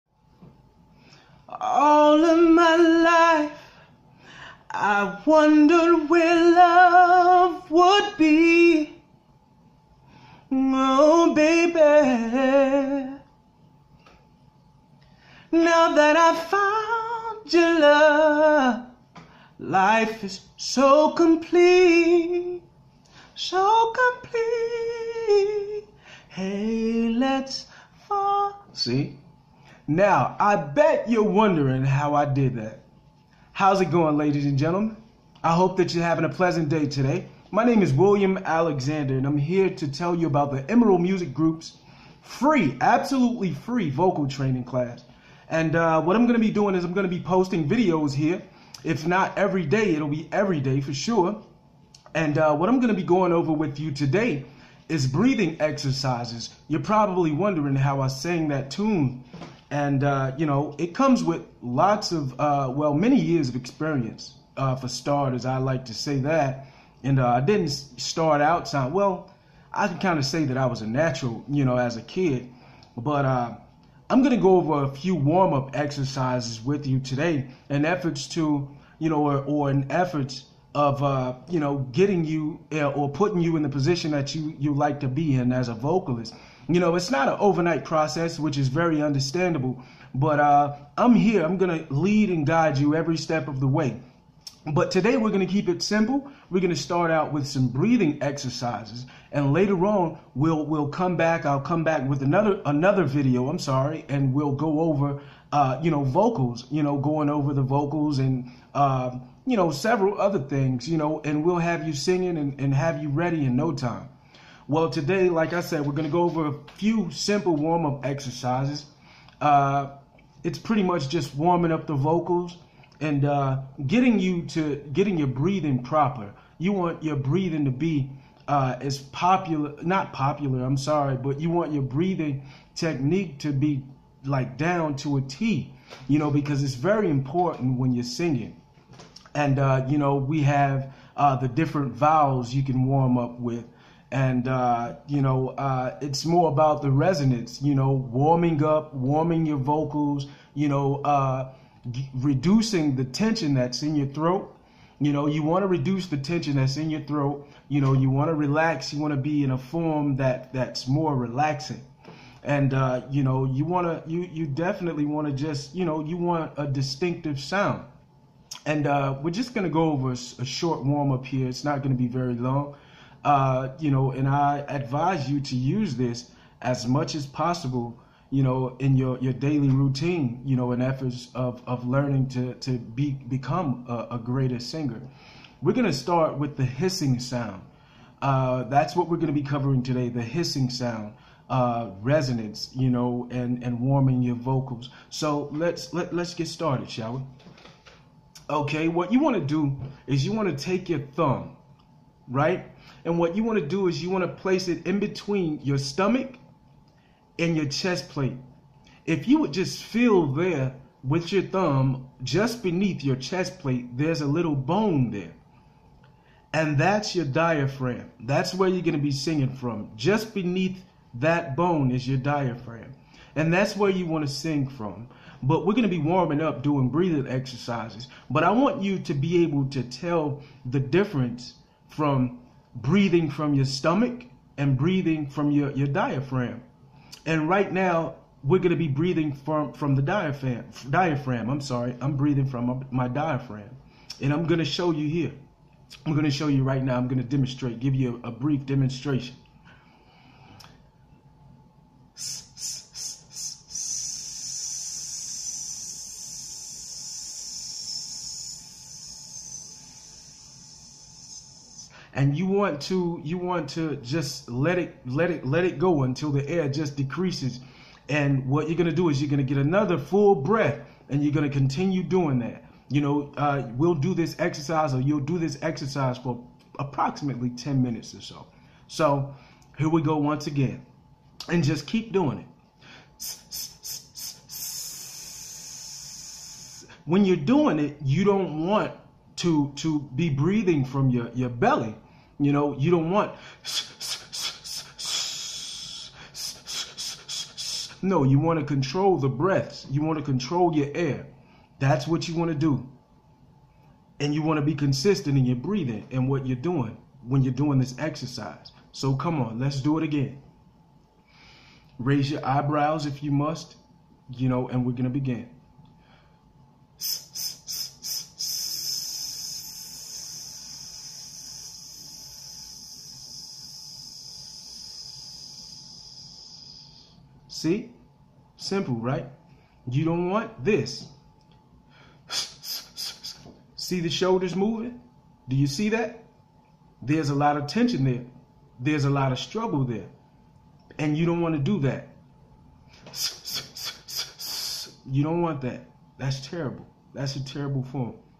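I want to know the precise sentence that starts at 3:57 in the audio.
And right now, we're going to be breathing from, from the diaphragm.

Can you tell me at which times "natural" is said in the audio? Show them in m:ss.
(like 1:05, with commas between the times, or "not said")
1:10.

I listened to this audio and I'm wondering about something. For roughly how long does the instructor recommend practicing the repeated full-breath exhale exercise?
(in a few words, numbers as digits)
10 minutes.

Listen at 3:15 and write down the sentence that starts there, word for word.
So let's let let's get started, shall we?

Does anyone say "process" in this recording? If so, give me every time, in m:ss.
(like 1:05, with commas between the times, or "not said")
1:27.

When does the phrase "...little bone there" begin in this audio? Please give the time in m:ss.
3:34.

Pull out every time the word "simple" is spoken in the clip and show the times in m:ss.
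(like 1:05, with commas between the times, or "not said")
1:35, 1:57, 5:28.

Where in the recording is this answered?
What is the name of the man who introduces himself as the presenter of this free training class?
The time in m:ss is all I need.
0:37.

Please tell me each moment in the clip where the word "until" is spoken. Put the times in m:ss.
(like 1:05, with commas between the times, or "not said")
4:26.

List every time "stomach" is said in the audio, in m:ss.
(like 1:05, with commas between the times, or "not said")
3:25, 3:53.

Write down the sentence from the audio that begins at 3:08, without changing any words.
Uh, that's what we're going to be covering today, the hissing sound.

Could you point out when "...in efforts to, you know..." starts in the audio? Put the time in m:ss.
1:17.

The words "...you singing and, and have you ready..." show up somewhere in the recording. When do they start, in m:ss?
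1:51.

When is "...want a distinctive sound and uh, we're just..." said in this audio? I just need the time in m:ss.
2:46.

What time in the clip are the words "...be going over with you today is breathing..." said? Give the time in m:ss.
0:53.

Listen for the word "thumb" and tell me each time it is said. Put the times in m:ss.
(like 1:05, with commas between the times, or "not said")
3:21, 3:31.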